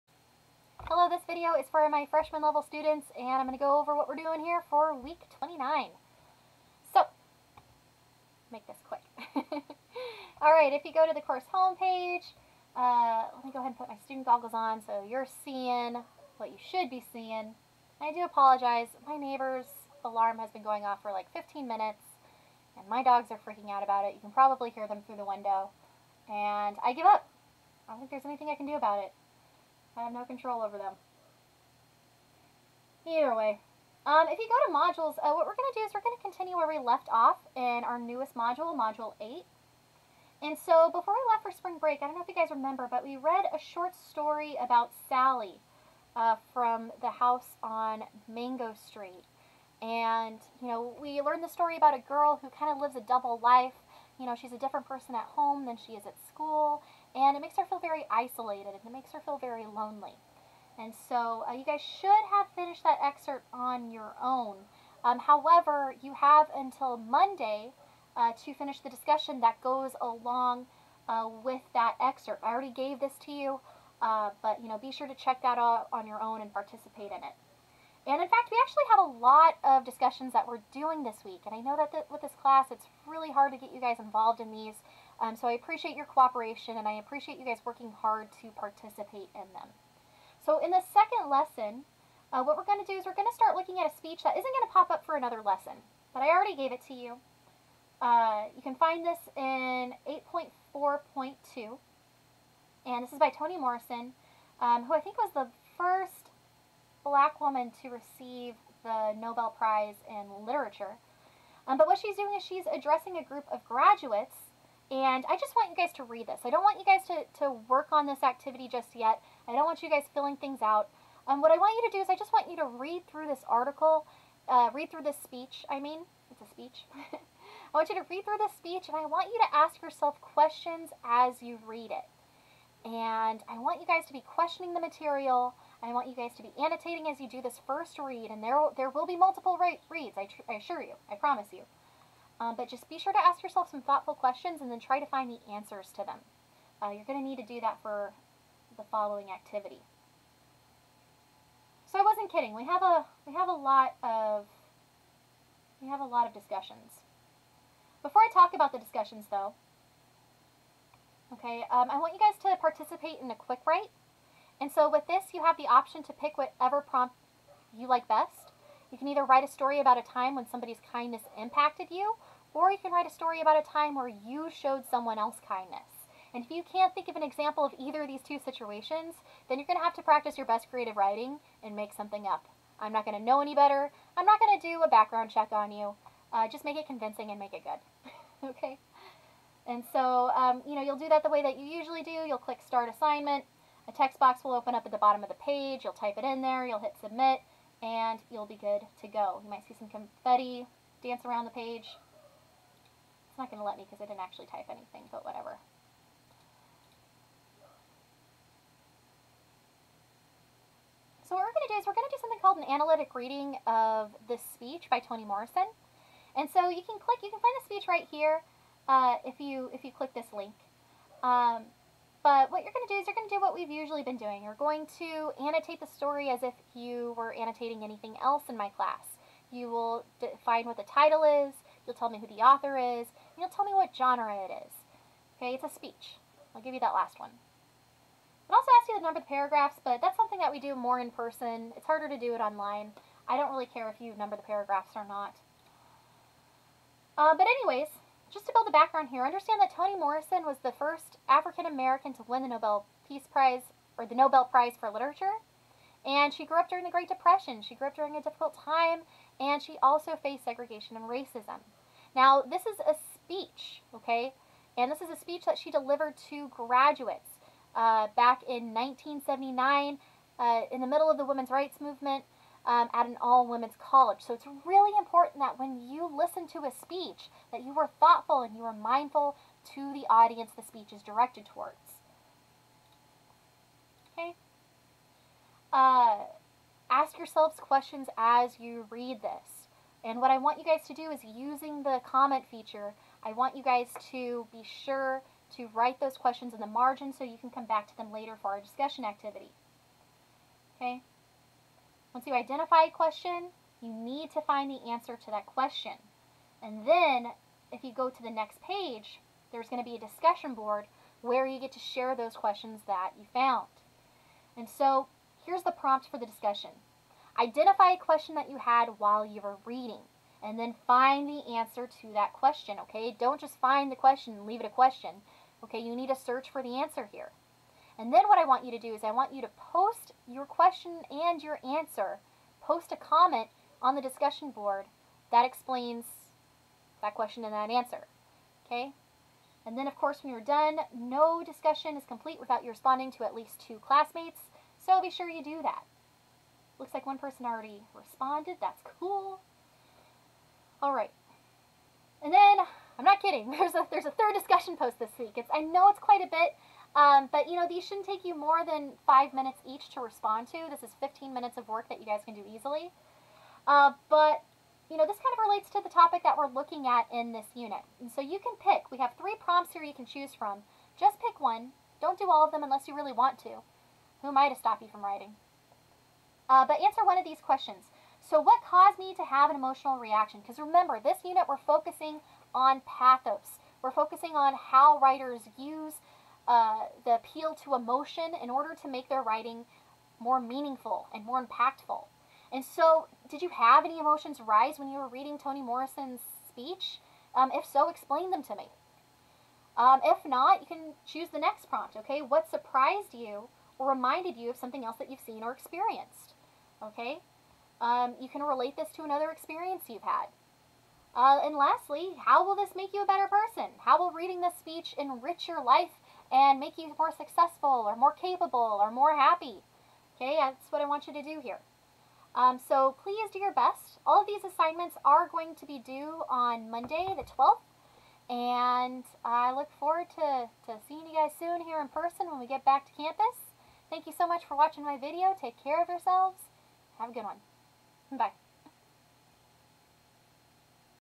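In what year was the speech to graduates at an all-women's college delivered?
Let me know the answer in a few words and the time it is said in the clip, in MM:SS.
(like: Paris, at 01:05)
1979, at 04:28.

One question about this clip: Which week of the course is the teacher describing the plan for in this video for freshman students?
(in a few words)
29.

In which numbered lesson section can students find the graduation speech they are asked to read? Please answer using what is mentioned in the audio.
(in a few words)
8.4.2.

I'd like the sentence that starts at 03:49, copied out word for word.
You will define what the title is, you'll tell me who the author is, You'll tell me what genre it is.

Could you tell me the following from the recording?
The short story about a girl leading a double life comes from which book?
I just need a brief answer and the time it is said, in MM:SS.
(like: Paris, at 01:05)
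The House on Mango Street, at 00:47.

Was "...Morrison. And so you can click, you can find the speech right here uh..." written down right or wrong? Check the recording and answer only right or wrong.
right.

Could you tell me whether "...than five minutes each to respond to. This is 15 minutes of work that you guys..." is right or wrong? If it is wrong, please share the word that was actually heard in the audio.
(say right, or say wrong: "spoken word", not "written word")
right.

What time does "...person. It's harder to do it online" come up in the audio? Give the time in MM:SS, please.
04:01.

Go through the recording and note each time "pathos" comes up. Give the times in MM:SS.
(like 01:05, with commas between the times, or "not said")
06:22.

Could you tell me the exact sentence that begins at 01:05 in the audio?
Um, however, you have until Monday uh, to finish the discussion that goes along uh, with that excerpt.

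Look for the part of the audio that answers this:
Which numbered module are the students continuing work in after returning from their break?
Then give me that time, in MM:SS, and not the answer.
00:38.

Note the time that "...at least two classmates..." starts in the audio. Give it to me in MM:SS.
05:43.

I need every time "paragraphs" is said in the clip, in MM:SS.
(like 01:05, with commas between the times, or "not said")
03:59, 04:04.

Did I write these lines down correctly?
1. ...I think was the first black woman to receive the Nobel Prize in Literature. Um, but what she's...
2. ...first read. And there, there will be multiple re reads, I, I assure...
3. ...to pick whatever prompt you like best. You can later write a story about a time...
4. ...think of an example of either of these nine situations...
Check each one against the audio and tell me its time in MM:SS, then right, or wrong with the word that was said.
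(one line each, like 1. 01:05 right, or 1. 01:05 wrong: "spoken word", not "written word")
1. 01:44 right
2. 02:17 right
3. 02:46 wrong: "either", not "later"
4. 02:56 wrong: "two", not "nine".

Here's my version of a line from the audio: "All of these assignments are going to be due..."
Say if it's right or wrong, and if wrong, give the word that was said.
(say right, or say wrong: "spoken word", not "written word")
right.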